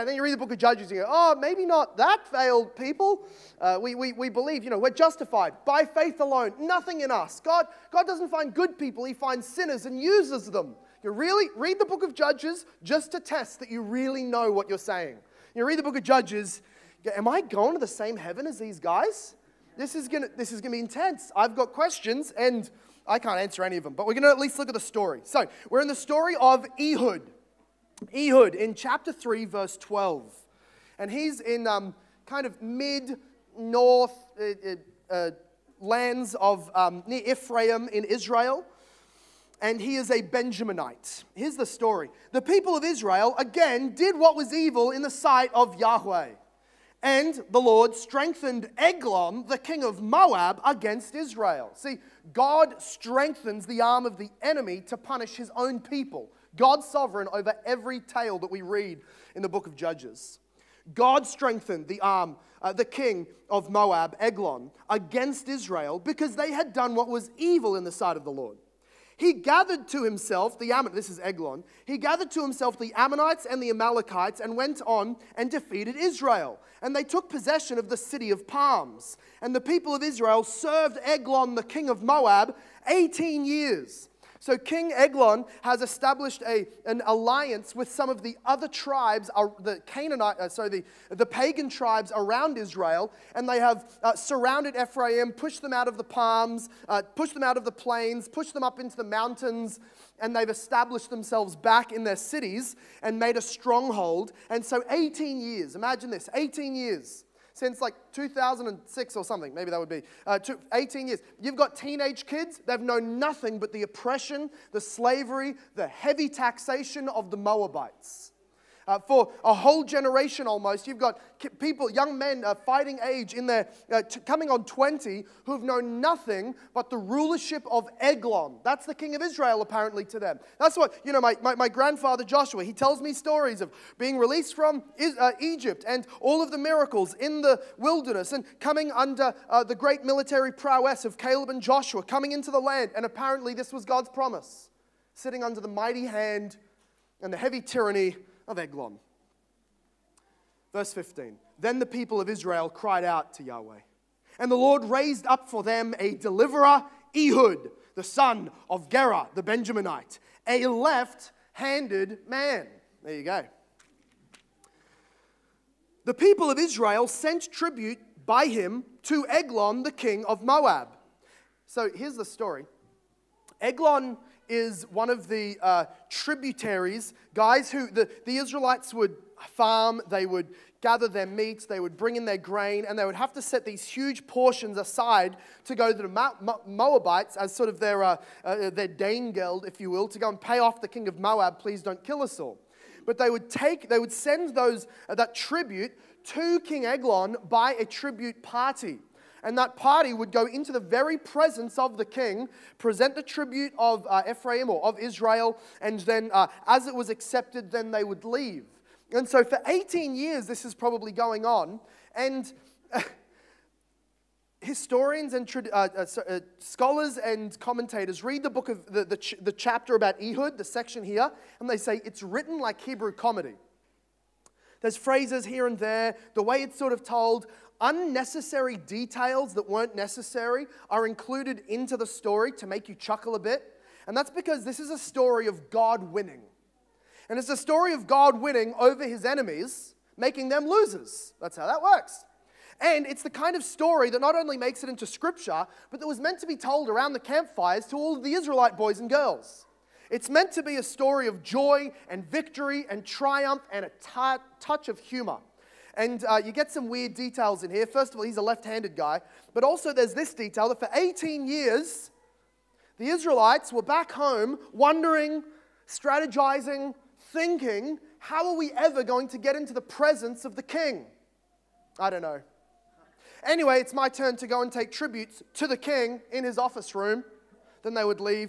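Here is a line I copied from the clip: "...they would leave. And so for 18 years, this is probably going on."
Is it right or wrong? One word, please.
right.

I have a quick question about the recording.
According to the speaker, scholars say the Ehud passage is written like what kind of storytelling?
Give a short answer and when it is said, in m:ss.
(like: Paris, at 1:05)
Hebrew comedy, at 3:42.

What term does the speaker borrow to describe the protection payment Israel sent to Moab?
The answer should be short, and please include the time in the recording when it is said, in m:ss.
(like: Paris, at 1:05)
Danegeld, at 3:08.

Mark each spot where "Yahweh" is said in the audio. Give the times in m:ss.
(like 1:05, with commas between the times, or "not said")
0:45, 2:33.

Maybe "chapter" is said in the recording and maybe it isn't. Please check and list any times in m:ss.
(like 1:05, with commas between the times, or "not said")
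0:28, 3:39.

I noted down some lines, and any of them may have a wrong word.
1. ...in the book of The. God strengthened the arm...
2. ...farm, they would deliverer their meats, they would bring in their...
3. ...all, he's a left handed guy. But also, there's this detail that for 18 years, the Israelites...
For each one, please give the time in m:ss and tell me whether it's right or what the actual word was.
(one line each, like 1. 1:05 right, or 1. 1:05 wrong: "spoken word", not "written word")
1. 0:59 wrong: "Judges", not "The"
2. 2:59 wrong: "gather", not "deliverer"
3. 4:18 right.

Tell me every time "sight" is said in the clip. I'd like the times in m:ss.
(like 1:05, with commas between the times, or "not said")
0:45, 1:07.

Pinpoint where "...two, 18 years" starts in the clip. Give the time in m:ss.
1:50.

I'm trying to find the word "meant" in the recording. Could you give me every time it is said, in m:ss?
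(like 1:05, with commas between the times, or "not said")
4:06, 4:10.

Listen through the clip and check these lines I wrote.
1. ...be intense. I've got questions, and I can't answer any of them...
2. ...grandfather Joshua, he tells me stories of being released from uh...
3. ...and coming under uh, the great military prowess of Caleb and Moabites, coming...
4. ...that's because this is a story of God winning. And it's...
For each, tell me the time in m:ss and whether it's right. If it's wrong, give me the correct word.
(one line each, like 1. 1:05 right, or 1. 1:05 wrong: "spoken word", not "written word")
1. 0:20 right
2. 2:11 right
3. 2:18 wrong: "Joshua", not "Moabites"
4. 3:54 right.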